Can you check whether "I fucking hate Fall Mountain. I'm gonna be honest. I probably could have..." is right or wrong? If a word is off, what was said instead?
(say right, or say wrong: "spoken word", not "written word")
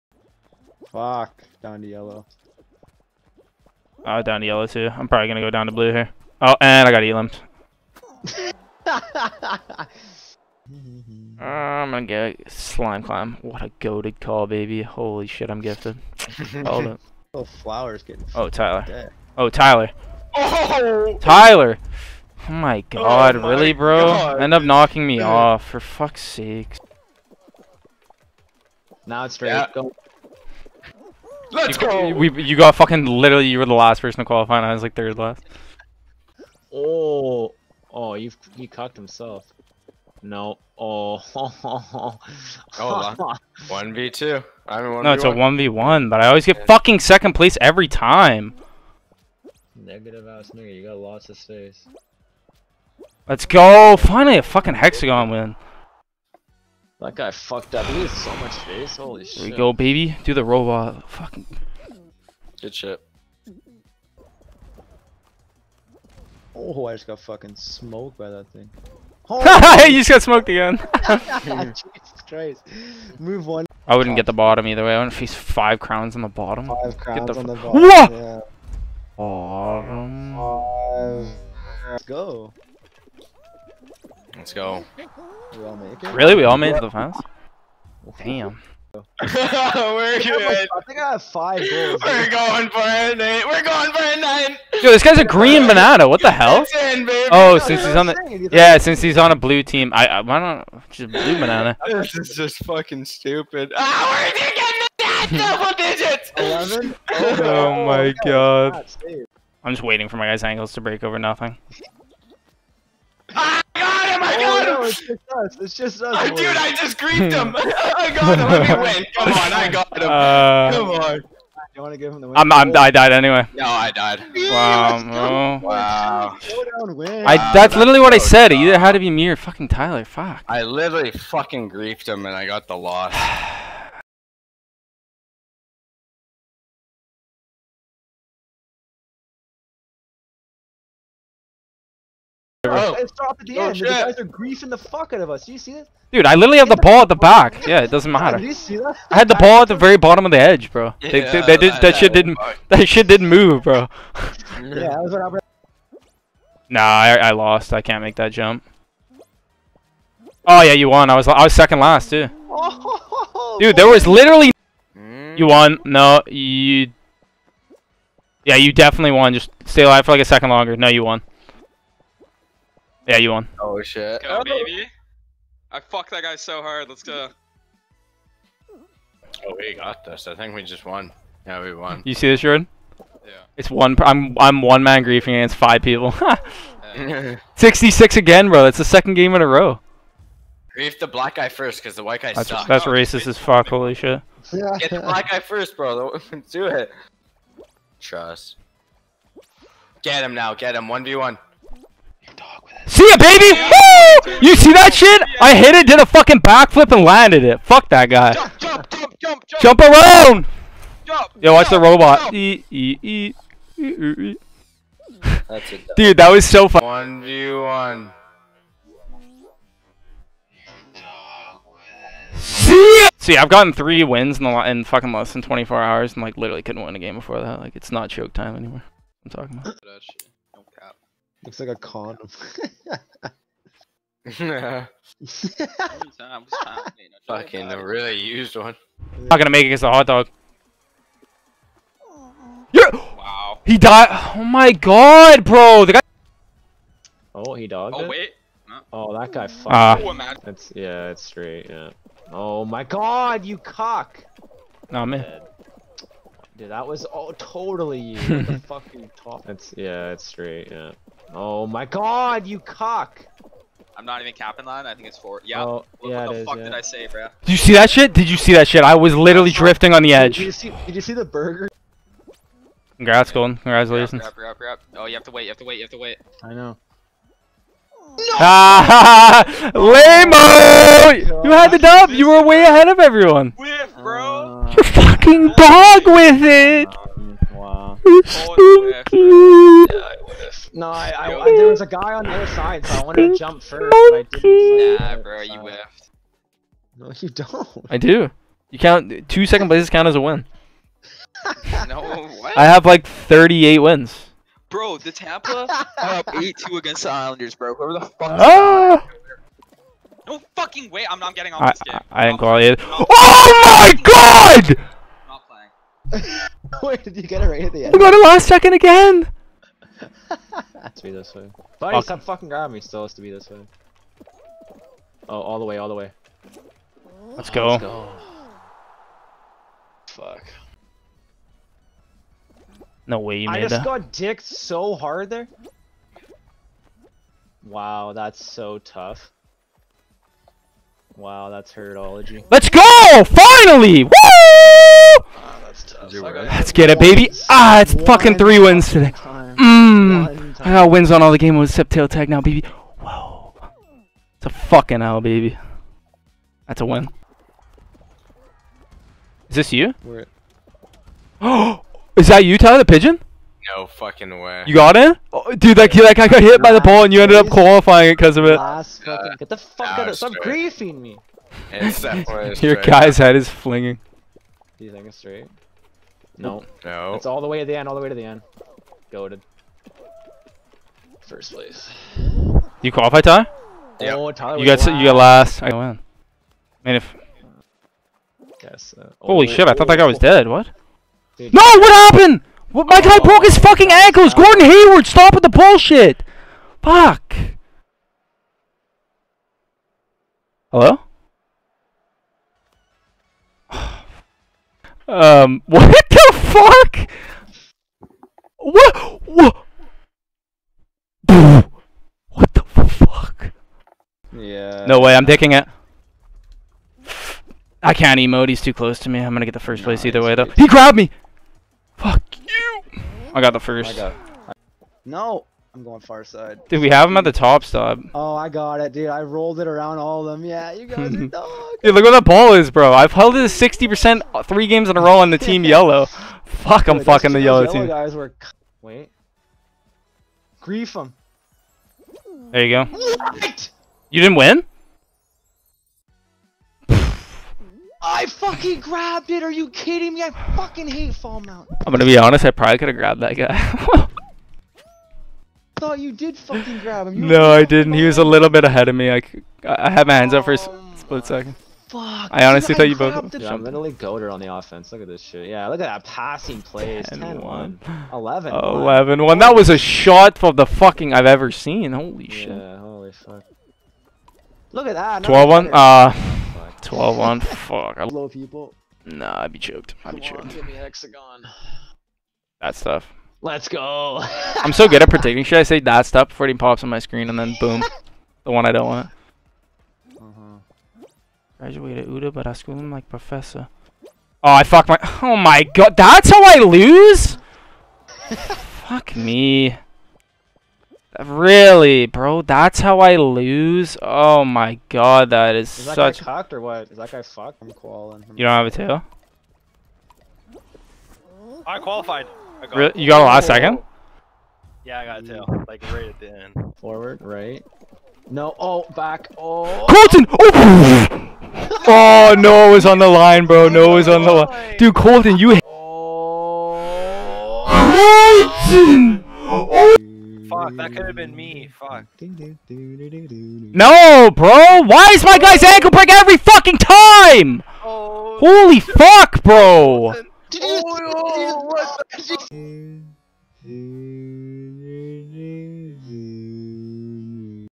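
right.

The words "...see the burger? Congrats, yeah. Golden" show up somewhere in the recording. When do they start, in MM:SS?
04:31.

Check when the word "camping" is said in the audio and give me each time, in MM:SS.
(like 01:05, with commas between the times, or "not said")
not said.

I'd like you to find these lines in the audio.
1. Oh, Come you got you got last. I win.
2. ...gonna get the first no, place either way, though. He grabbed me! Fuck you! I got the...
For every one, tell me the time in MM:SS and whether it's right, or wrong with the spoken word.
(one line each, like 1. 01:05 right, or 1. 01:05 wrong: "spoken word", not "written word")
1. 06:24 wrong: "Tyler", not "Come"
2. 06:59 right.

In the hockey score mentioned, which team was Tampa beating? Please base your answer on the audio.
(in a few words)
Islanders.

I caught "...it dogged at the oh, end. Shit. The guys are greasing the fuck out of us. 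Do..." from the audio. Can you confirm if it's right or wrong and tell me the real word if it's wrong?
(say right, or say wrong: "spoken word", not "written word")
wrong: "stopped", not "dogged".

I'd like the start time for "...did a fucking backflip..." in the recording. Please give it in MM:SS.
03:25.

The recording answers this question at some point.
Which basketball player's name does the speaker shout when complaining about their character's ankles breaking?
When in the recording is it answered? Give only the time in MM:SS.
06:34.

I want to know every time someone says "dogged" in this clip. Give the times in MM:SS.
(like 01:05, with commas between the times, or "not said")
04:07.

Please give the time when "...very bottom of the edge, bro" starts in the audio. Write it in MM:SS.
02:29.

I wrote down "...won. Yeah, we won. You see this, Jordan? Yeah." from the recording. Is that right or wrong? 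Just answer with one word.
right.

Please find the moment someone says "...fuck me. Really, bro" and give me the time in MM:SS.
08:18.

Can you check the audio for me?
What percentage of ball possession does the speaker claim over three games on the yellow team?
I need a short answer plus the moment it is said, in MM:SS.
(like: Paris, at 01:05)
60%, at 07:13.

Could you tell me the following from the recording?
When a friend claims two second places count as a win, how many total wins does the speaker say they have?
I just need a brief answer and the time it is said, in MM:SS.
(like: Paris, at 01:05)
38, at 05:03.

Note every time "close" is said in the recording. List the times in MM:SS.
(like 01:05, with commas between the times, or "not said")
06:58.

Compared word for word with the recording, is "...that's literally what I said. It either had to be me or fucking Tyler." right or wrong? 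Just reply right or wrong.
right.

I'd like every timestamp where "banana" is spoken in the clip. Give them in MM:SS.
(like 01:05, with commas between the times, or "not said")
01:35, 01:41.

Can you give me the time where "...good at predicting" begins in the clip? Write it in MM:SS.
08:04.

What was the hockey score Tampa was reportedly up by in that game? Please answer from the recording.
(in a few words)
8-2.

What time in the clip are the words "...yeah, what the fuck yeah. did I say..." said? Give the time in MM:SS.
04:26.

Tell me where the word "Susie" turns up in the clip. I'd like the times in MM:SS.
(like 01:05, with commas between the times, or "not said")
not said.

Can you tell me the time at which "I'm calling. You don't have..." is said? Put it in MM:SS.
08:27.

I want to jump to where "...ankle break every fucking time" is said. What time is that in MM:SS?
08:55.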